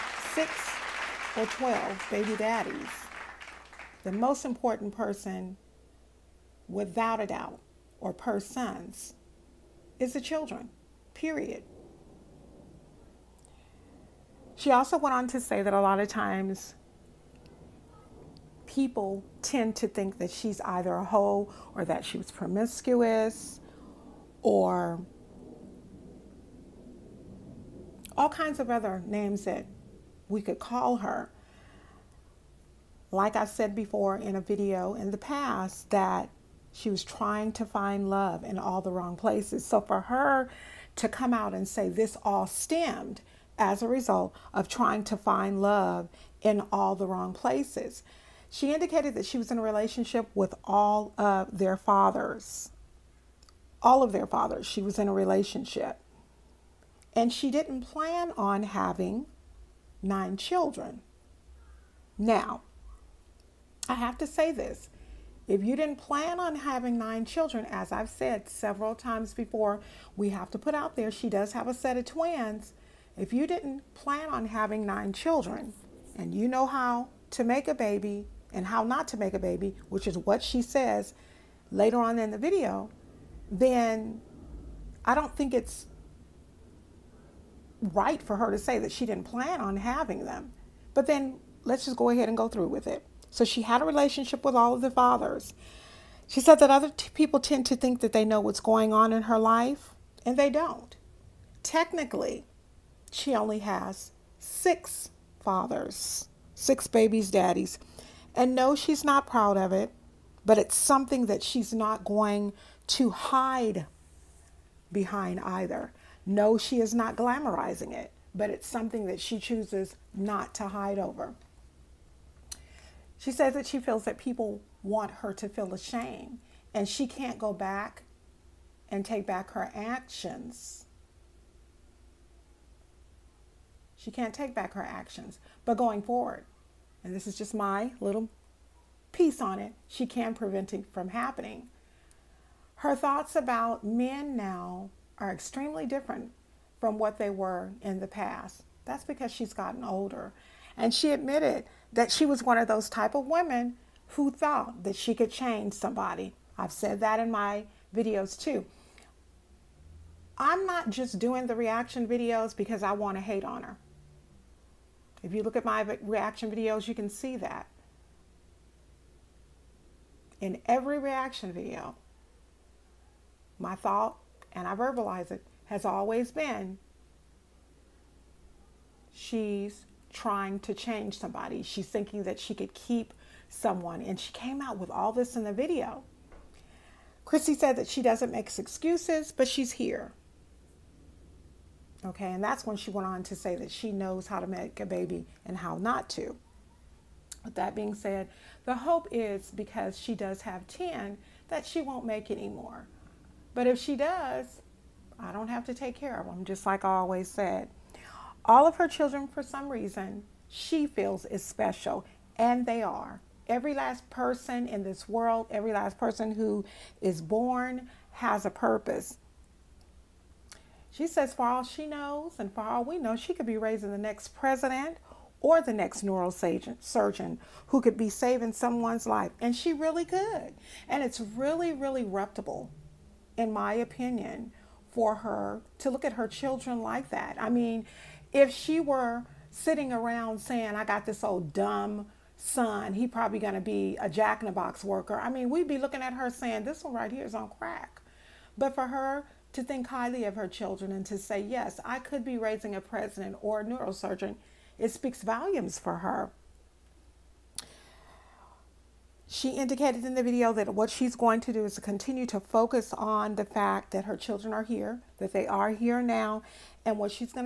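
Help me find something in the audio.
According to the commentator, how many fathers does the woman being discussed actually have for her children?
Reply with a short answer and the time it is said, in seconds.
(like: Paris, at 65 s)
6, at 104 s.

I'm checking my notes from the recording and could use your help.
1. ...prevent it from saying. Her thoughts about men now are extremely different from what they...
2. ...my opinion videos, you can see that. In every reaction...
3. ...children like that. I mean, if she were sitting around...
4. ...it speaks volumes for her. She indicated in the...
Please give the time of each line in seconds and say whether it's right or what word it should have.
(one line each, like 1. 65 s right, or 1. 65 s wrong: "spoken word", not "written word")
1. 140 s wrong: "happening", not "saying"
2. 165 s wrong: "reaction", not "opinion"
3. 236 s right
4. 254 s right.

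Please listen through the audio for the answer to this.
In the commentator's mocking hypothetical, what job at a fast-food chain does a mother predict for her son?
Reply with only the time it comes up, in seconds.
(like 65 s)
244 s.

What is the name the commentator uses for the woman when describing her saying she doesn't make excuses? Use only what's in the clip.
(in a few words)
Chrissy.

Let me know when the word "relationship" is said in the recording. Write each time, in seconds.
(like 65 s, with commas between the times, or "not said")
49 s, 55 s, 93 s.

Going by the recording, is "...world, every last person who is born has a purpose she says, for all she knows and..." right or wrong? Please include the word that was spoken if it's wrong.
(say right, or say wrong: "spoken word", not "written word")
right.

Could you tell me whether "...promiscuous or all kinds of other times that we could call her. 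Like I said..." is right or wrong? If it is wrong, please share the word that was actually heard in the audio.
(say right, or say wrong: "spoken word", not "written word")
wrong: "names", not "times".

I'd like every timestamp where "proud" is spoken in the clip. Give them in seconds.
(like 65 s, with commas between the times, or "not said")
109 s.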